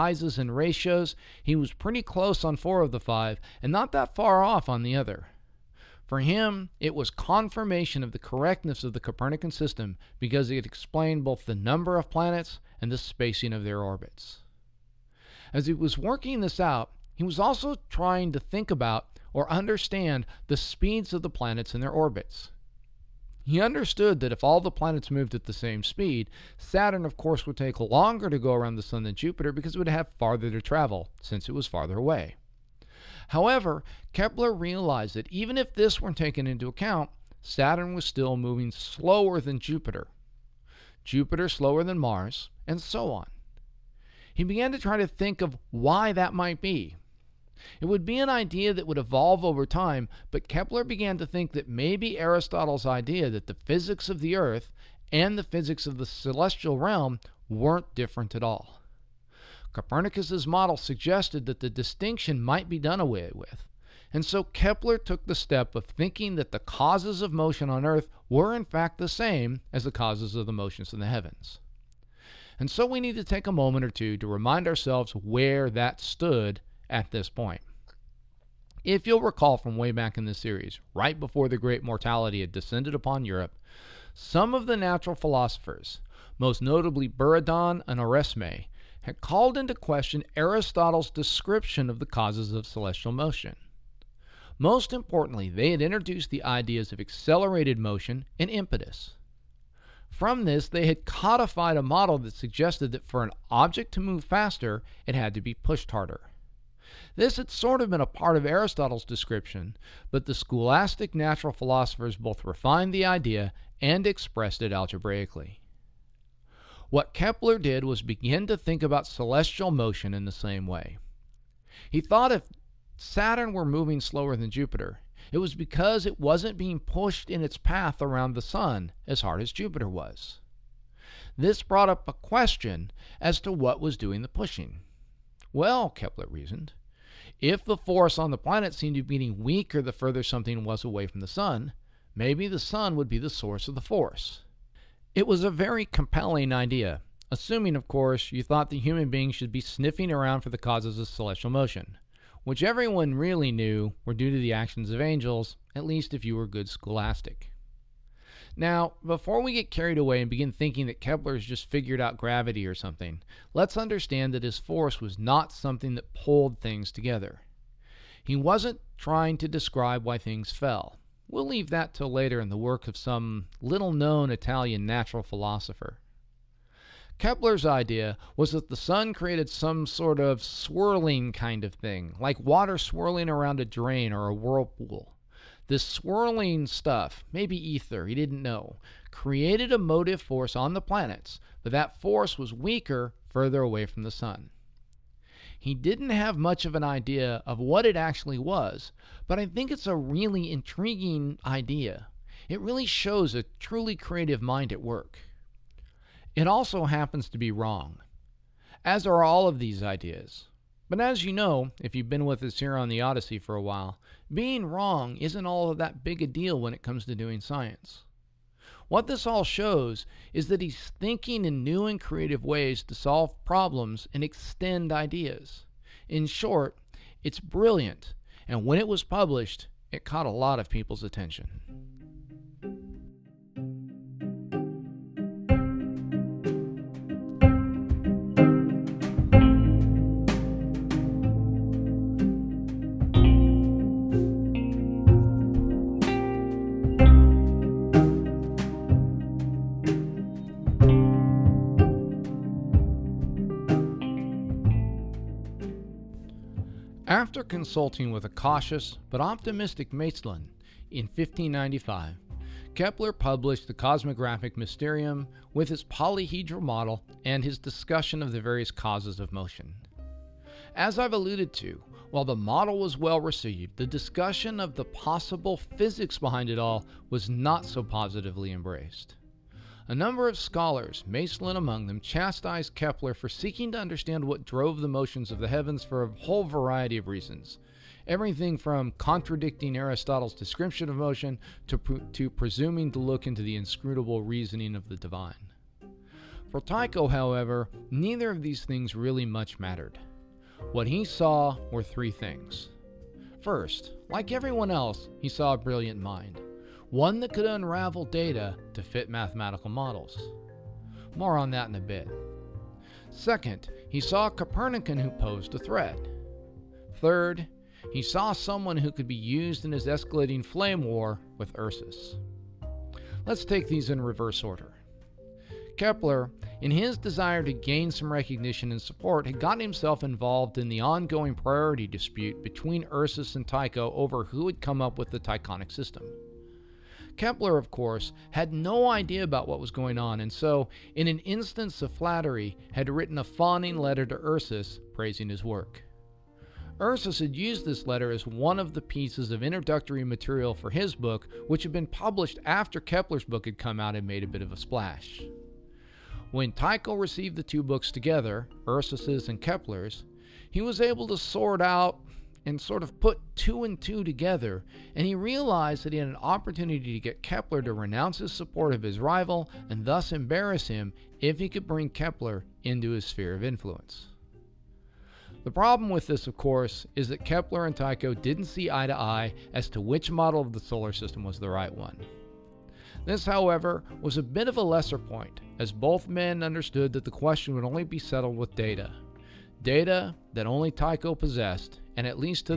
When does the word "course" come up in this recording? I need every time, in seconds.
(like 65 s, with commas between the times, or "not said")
27 s, 147 s, 337 s, 376 s.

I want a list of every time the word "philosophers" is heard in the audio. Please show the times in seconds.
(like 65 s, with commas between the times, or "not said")
85 s, 111 s, 175 s.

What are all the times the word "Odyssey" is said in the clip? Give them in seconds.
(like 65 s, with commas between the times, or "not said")
213 s.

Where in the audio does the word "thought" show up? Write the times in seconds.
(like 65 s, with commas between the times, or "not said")
121 s, 148 s.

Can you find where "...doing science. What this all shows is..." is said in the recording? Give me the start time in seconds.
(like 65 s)
217 s.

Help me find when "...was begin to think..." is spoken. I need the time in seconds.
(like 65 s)
117 s.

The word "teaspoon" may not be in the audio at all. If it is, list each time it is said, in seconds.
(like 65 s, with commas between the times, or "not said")
not said.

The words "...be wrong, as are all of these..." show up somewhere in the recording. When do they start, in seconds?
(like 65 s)
207 s.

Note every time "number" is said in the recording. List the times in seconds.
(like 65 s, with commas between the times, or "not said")
11 s, 279 s.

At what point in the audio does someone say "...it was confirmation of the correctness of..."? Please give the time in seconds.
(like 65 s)
6 s.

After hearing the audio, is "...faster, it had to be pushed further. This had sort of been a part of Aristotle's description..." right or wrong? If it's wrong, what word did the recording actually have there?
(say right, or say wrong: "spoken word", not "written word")
wrong: "harder", not "further".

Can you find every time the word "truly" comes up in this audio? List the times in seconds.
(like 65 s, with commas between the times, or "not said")
203 s.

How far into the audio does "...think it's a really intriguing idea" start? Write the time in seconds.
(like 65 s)
199 s.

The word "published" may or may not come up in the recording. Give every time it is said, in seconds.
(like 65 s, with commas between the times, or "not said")
229 s, 263 s, 351 s.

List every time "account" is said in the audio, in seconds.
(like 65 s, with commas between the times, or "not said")
36 s.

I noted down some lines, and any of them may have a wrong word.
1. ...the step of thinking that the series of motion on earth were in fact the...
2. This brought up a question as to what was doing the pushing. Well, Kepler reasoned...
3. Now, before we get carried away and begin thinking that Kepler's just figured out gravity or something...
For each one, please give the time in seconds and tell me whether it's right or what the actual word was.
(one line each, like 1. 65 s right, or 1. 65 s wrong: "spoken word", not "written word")
1. 65 s wrong: "causes", not "series"
2. 131 s right
3. 158 s right.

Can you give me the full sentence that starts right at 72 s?
And so we need to take a moment or two to remind ourselves where that stood at this point.